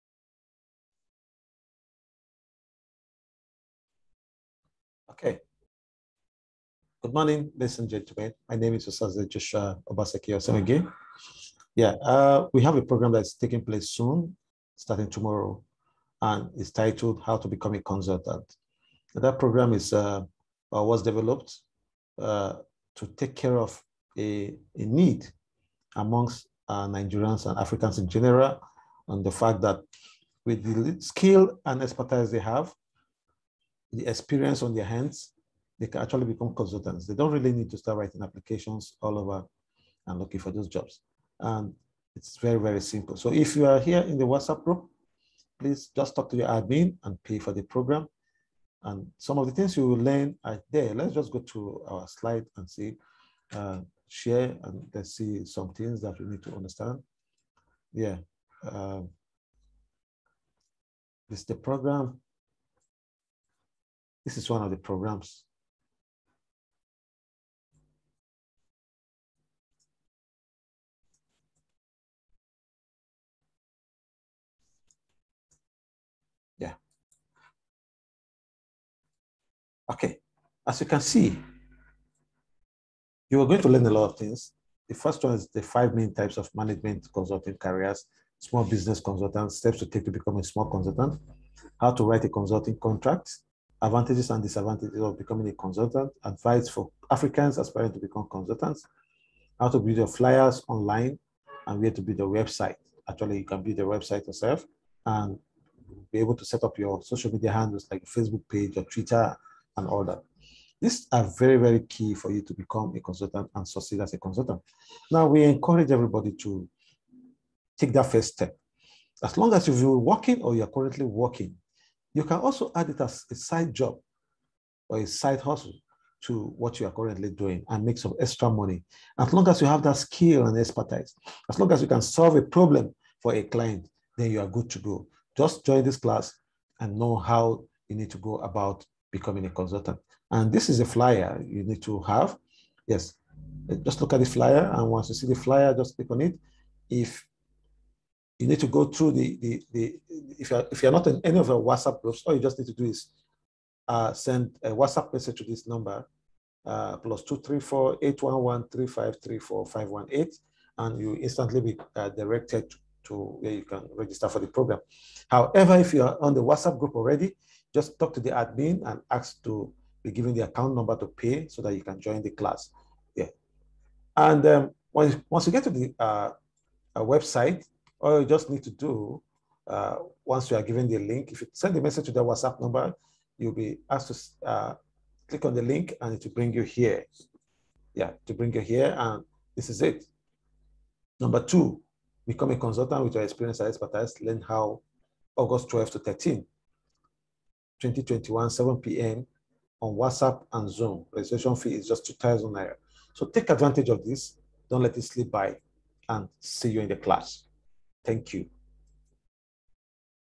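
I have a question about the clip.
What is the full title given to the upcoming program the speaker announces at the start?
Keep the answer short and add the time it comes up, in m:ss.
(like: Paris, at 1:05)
How to Become a Consultant, at 0:17.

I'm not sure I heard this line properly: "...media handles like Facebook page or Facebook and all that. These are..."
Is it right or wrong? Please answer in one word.
wrong.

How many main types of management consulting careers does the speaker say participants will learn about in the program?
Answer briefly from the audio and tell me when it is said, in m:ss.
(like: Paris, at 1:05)
5, at 1:25.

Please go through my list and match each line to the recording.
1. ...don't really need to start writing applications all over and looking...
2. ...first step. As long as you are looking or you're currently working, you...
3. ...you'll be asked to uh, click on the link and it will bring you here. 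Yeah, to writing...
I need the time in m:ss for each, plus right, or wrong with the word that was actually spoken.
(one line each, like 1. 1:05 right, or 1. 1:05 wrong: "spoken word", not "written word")
1. 0:37 right
2. 1:58 wrong: "working", not "looking"
3. 3:03 wrong: "bring", not "writing".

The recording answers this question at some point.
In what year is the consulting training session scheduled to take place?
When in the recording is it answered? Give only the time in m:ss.
3:17.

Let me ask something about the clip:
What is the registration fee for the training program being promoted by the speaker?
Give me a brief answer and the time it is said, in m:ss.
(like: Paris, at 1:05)
2,000 naira, at 3:22.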